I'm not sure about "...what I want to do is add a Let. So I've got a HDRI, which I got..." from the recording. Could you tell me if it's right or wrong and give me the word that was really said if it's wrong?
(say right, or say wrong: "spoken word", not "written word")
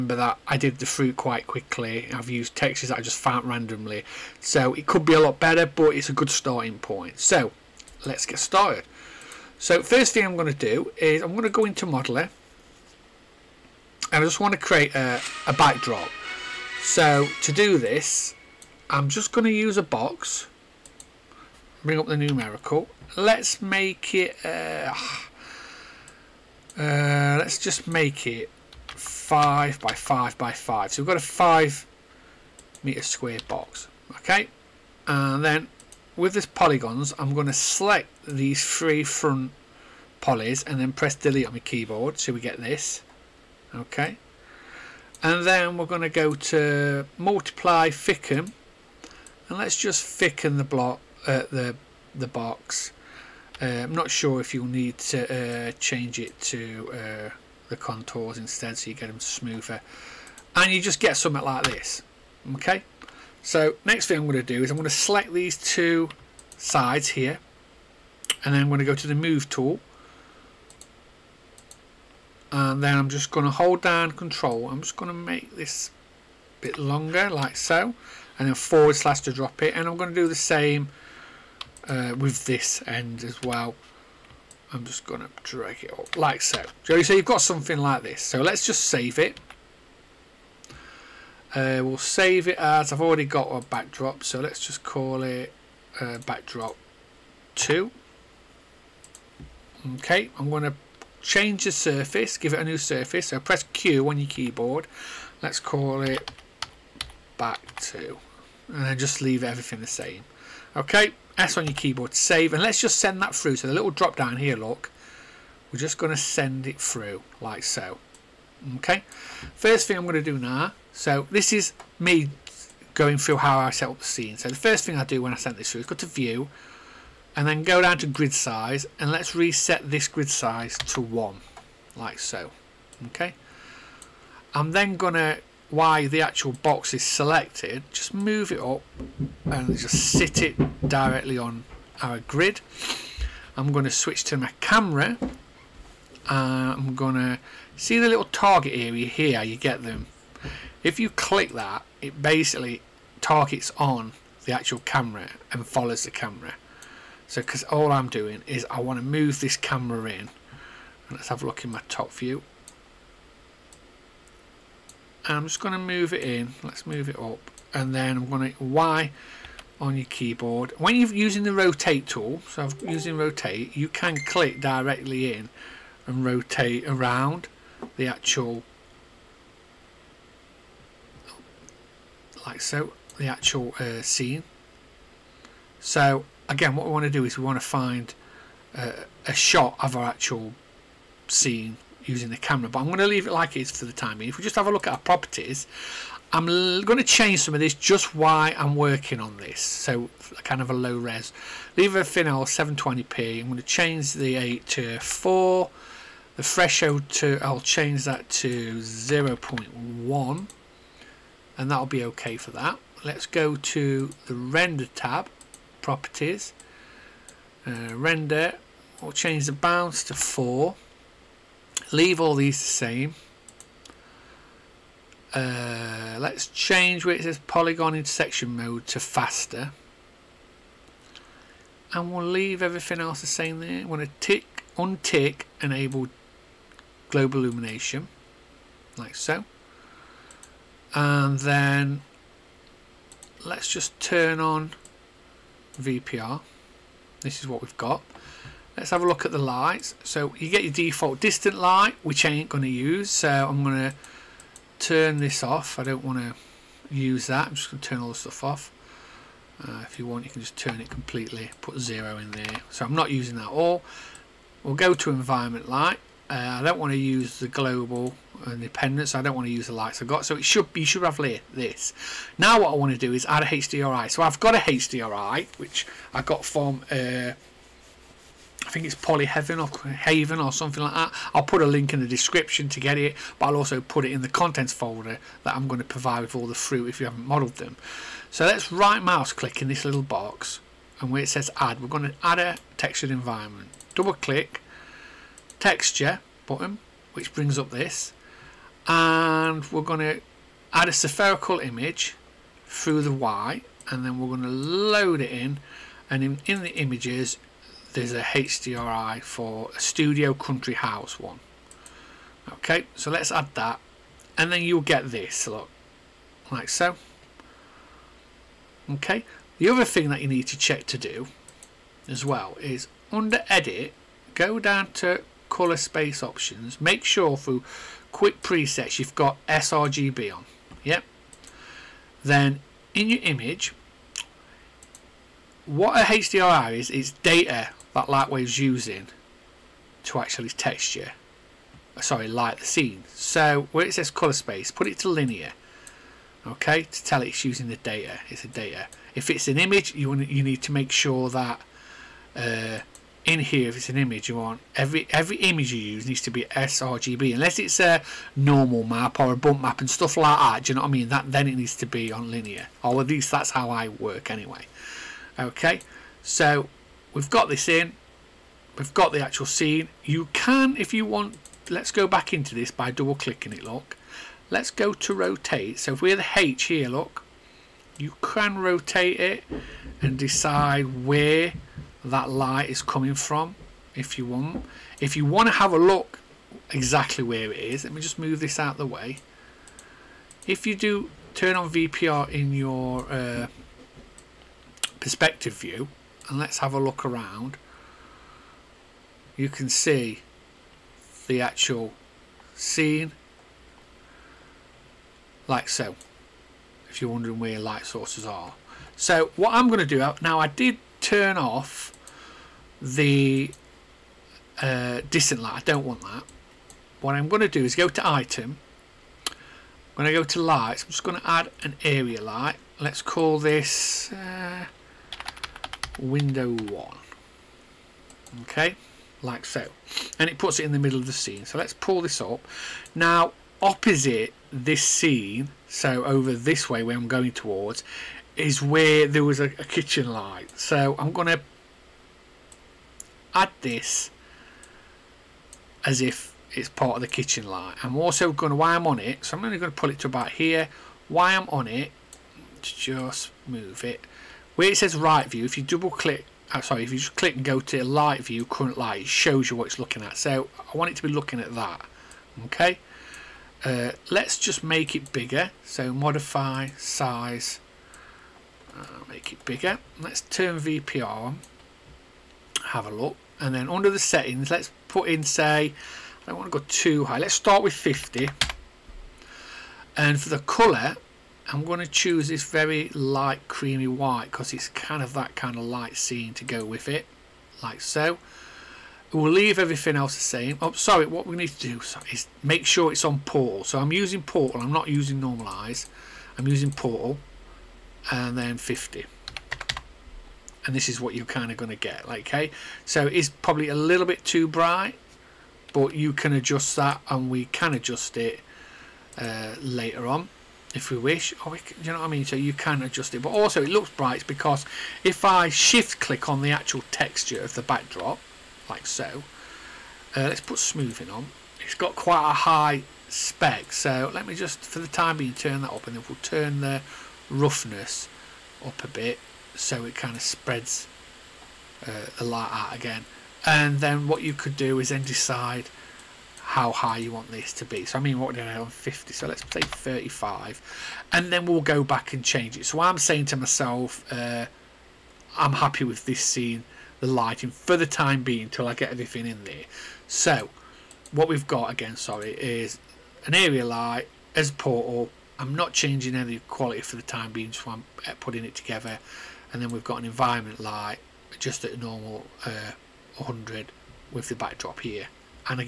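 wrong: "HDRI", not "Let".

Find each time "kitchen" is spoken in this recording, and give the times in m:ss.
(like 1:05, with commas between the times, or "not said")
7:19, 7:27.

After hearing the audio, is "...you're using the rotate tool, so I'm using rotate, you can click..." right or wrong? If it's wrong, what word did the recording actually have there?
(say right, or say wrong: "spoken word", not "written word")
right.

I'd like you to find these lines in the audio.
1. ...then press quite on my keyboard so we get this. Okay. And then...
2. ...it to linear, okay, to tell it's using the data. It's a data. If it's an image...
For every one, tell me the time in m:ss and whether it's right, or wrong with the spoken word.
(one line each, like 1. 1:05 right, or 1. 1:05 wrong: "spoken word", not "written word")
1. 0:40 wrong: "delete", not "quite"
2. 5:44 right.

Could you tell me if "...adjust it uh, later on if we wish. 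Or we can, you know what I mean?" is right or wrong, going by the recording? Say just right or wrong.
right.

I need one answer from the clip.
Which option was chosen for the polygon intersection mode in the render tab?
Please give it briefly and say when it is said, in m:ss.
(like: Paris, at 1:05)
faster, at 3:48.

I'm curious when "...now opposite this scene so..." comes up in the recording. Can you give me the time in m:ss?
7:12.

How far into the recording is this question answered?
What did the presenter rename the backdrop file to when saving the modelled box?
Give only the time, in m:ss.
1:36.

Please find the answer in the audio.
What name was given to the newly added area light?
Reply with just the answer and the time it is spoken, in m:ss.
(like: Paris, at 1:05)
window 1, at 7:05.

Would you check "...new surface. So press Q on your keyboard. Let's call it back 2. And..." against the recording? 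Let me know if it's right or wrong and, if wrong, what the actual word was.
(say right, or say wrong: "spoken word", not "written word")
right.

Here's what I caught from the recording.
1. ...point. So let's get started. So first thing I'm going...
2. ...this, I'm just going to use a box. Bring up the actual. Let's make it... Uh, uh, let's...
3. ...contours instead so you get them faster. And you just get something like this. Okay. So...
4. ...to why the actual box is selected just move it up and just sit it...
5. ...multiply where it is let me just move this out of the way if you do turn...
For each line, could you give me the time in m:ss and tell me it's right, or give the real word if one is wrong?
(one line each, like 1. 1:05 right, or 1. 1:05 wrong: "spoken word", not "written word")
1. 0:06 right
2. 0:17 wrong: "numerical", not "actual"
3. 0:57 wrong: "smoother", not "faster"
4. 2:15 right
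5. 6:26 wrong: "exactly", not "multiply".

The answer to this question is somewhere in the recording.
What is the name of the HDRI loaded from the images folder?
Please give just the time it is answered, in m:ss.
5:09.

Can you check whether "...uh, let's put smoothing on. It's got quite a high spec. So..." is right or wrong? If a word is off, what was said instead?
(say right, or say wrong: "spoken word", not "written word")
right.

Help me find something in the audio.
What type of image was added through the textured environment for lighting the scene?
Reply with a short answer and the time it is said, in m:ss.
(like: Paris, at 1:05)
spherical image, at 5:00.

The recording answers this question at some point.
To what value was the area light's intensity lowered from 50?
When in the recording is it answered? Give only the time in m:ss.
8:59.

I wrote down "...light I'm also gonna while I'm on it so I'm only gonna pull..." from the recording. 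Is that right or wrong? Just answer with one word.
right.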